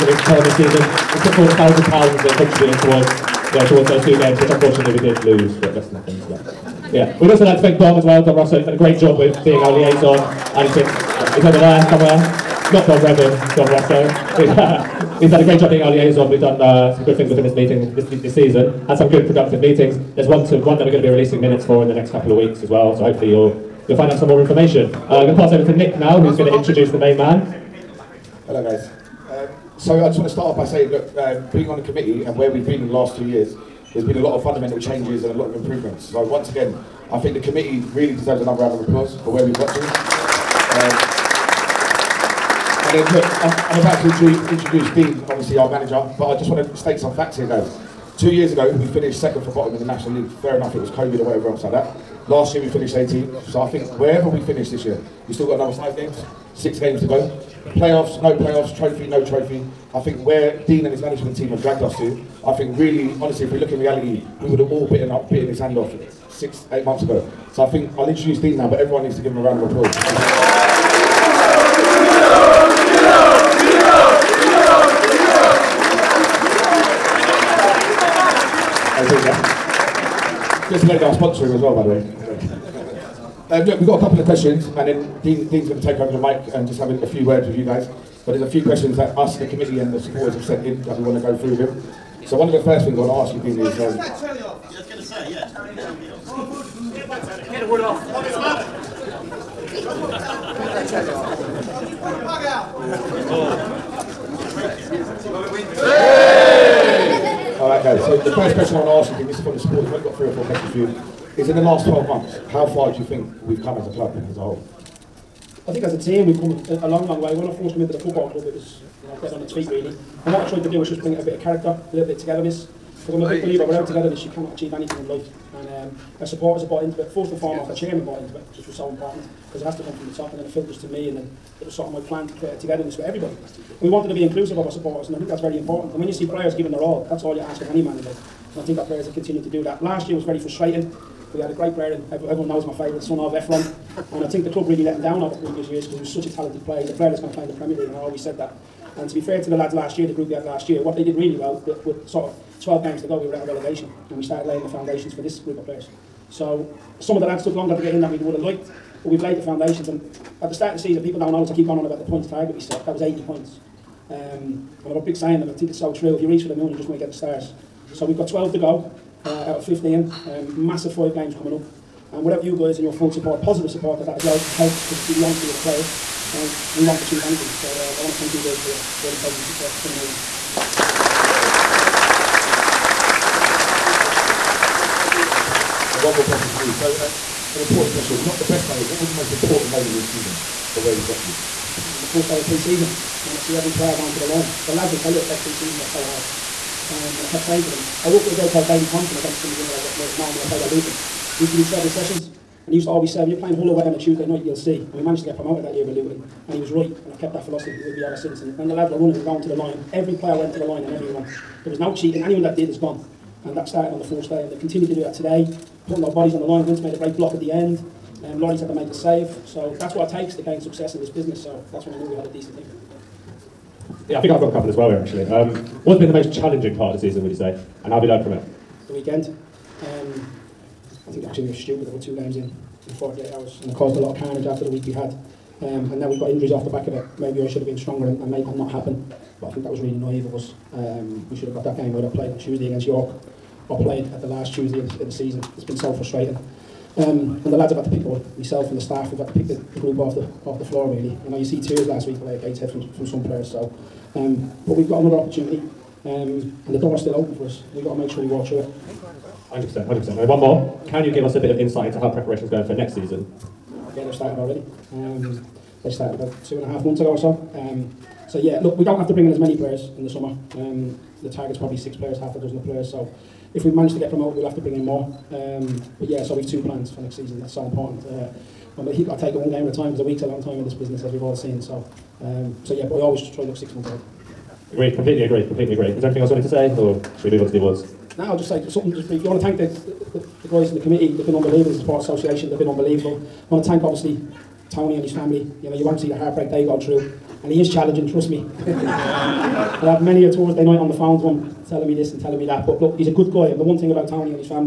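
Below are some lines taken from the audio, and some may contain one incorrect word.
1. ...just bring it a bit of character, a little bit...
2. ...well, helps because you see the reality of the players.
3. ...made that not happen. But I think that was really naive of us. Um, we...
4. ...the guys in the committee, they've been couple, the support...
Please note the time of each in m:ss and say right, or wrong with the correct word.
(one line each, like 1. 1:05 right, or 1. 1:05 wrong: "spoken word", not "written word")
1. 2:00 right
2. 2:54 wrong: "honesty", not "reality"
3. 3:58 right
4. 4:50 wrong: "unbelievable", not "couple".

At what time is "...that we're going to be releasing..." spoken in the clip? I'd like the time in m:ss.
0:20.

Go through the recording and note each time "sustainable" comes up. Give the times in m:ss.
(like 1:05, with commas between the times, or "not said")
not said.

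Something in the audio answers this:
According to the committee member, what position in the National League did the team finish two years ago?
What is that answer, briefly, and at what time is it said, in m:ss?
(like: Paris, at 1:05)
Second from bottom, at 0:49.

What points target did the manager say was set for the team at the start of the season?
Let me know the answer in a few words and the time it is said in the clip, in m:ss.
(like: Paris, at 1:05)
80 points, at 2:43.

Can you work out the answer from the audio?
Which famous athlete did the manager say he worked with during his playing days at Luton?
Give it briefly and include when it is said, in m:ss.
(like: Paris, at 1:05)
Daley Thompson, at 3:18.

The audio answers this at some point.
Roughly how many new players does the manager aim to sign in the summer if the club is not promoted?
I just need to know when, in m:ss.
4:31.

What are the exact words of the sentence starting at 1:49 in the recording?
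We've only got three or four questions for you.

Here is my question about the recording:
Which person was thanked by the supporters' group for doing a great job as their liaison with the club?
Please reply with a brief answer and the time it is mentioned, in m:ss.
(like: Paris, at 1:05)
Dom Russell, at 0:08.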